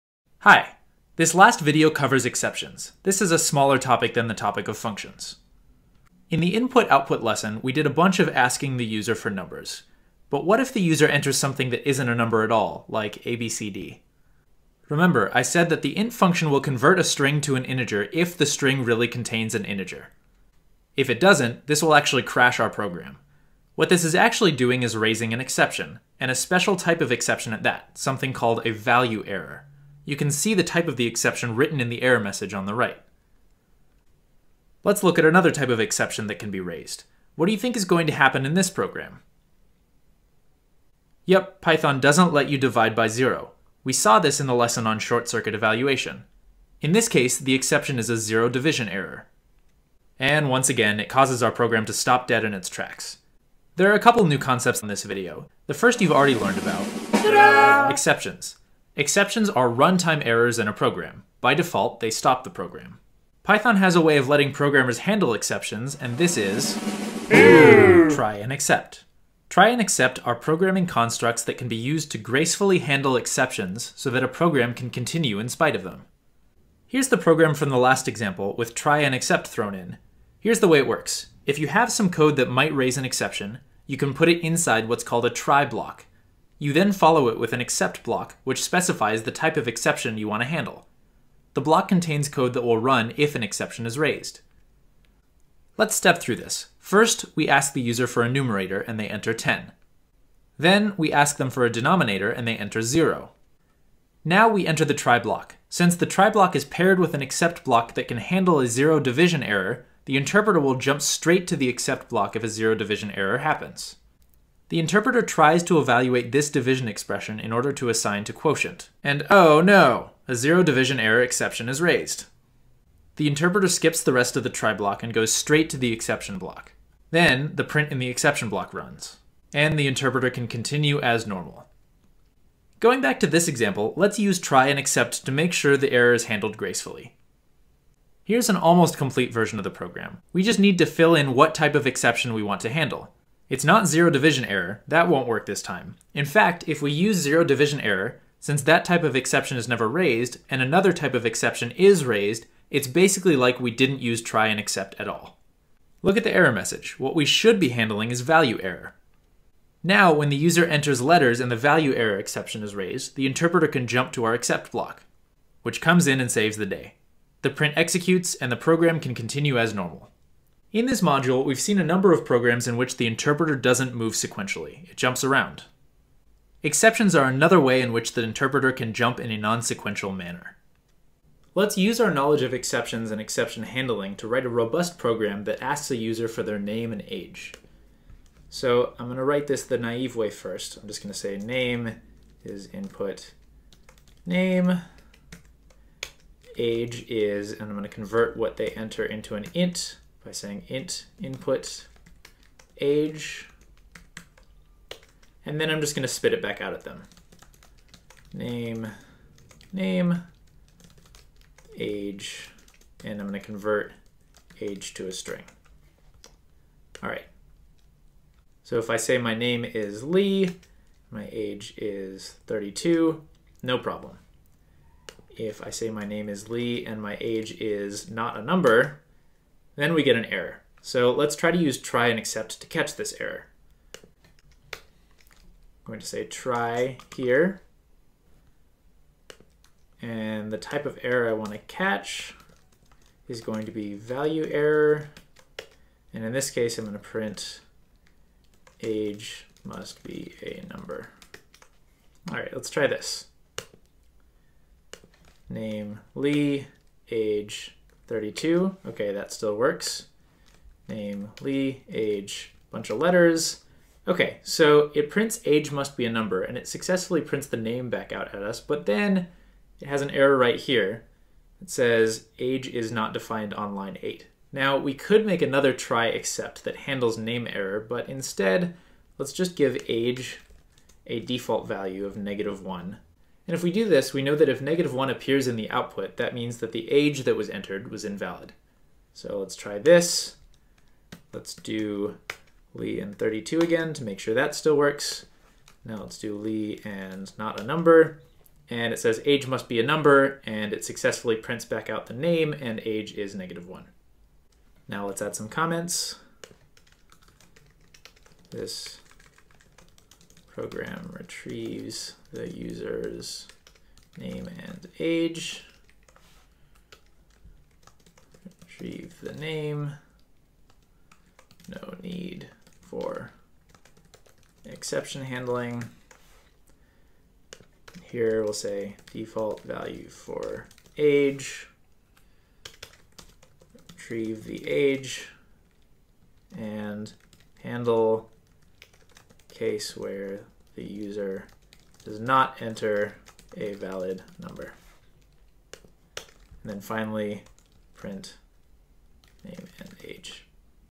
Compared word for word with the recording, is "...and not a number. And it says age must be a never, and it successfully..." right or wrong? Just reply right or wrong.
wrong.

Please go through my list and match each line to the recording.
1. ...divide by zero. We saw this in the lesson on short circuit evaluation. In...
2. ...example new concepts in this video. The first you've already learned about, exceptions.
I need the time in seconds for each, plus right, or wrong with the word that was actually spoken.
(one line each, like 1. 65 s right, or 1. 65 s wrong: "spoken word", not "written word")
1. 42 s right
2. 53 s wrong: "couple", not "example".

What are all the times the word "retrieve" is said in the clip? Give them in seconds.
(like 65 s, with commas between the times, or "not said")
311 s, 318 s, 333 s.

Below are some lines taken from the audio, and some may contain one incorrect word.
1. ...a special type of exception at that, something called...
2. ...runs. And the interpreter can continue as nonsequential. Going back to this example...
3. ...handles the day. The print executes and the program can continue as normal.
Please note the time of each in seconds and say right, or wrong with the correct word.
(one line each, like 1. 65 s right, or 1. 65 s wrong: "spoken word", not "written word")
1. 26 s right
2. 128 s wrong: "normal", not "nonsequential"
3. 166 s wrong: "saves", not "handles".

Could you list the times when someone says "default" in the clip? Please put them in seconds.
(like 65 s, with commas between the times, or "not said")
61 s, 281 s, 329 s.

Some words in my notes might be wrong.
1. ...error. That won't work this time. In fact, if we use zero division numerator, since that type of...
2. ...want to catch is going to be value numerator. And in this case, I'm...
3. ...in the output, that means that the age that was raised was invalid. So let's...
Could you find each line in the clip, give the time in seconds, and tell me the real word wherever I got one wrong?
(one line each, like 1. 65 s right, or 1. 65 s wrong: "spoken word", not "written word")
1. 144 s wrong: "error", not "numerator"
2. 241 s wrong: "error", not "numerator"
3. 285 s wrong: "entered", not "raised".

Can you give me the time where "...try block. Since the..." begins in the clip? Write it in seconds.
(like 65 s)
104 s.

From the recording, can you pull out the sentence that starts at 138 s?
Here's an almost complete version of the program.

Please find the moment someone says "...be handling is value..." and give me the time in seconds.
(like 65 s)
157 s.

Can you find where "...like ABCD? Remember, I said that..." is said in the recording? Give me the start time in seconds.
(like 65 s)
12 s.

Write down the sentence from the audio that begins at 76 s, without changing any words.
Here's the program from the last example with try and except thrown in.